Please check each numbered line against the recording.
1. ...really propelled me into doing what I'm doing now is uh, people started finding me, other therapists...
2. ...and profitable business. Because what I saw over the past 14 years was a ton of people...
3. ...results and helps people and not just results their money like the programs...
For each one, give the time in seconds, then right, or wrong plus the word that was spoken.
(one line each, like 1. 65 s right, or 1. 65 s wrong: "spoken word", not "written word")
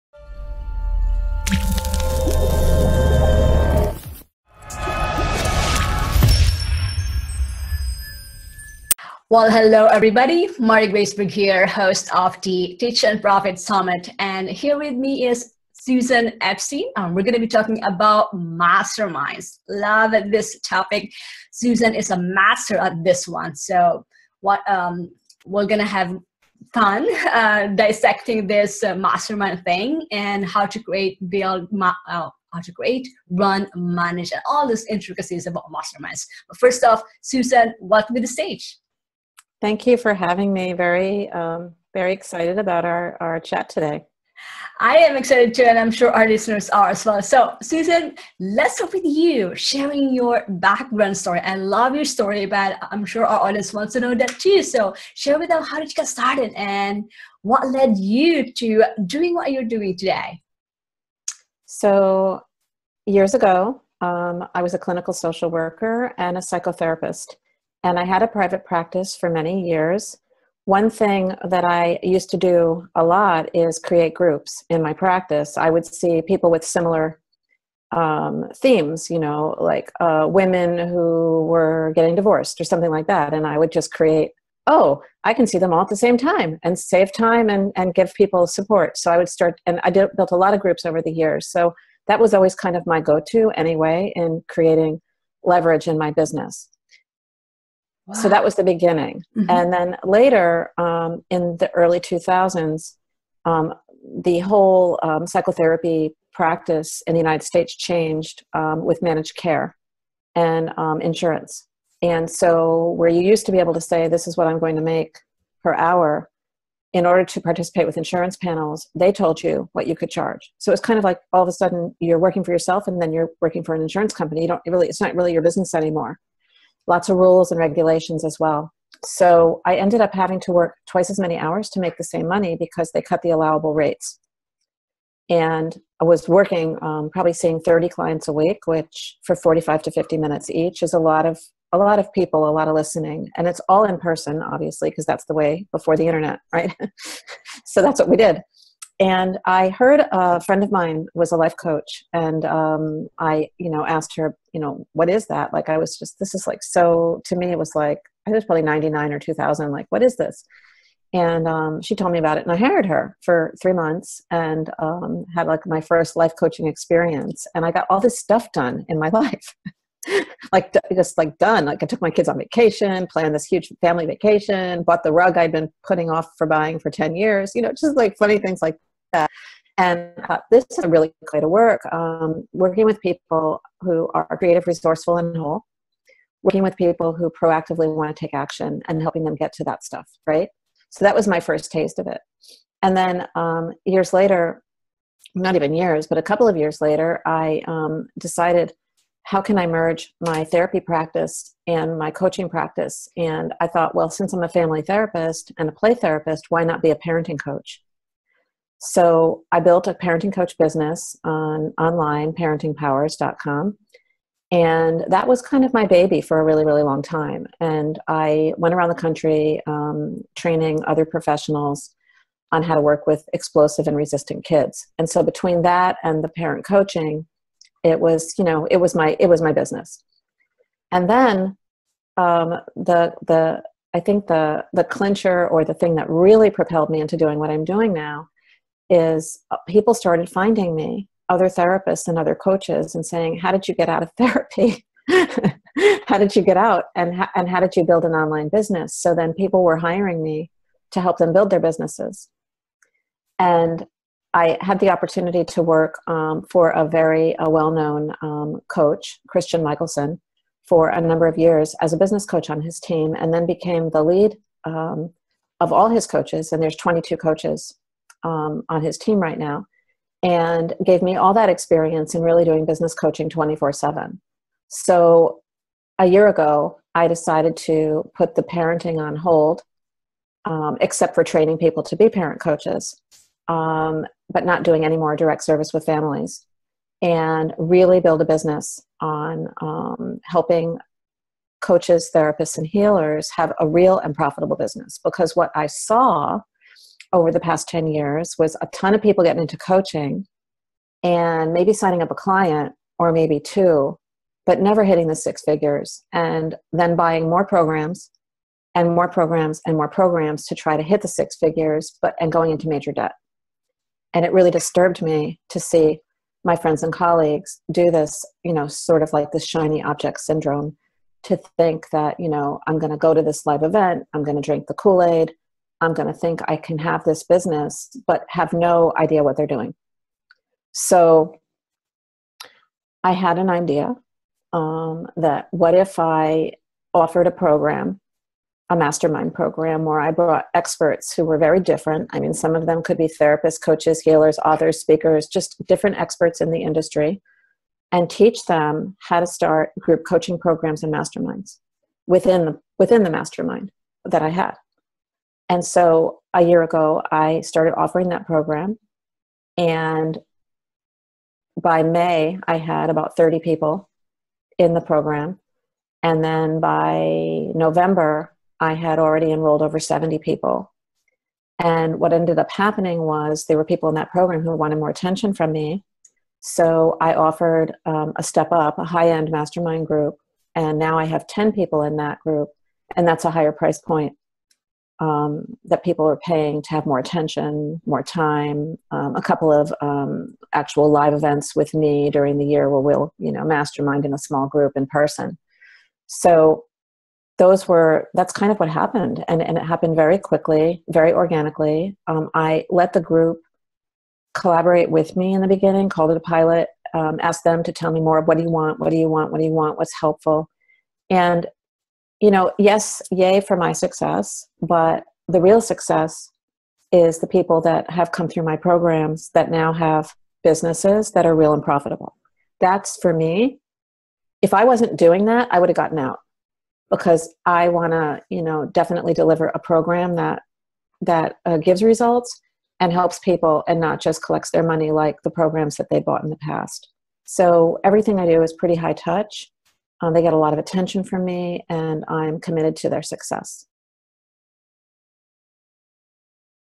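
1. 236 s right
2. 293 s wrong: "10", not "14"
3. 431 s wrong: "collects", not "results".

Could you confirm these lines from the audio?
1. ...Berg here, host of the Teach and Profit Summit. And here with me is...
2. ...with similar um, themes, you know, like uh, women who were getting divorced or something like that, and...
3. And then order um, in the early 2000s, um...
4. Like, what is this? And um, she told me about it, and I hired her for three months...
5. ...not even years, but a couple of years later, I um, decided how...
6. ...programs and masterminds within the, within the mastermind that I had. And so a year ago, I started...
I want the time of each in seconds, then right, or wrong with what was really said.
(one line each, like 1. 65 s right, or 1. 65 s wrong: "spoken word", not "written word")
1. 11 s right
2. 76 s right
3. 99 s wrong: "later", not "order"
4. 159 s right
5. 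195 s right
6. 350 s right.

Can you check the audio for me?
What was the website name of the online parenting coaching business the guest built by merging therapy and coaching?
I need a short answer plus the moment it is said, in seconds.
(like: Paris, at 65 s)
parentingpowers.com, at 212 s.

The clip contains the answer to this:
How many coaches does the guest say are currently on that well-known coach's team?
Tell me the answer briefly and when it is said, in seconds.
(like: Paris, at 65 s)
22, at 266 s.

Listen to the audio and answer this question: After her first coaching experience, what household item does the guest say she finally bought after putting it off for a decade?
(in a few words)
Rug.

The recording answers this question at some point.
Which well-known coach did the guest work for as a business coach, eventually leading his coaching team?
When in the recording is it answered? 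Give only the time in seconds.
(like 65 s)
259 s.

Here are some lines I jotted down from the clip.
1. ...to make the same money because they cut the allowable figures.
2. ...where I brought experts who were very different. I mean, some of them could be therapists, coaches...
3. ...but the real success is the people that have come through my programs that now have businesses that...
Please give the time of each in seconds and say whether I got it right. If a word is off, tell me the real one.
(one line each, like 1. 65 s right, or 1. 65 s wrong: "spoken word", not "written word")
1. 131 s wrong: "rates", not "figures"
2. 339 s right
3. 414 s right.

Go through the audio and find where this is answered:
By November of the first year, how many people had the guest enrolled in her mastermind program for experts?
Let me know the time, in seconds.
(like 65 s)
369 s.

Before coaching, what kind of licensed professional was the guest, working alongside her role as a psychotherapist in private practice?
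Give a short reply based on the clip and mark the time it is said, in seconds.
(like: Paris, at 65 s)
Clinical social worker, at 64 s.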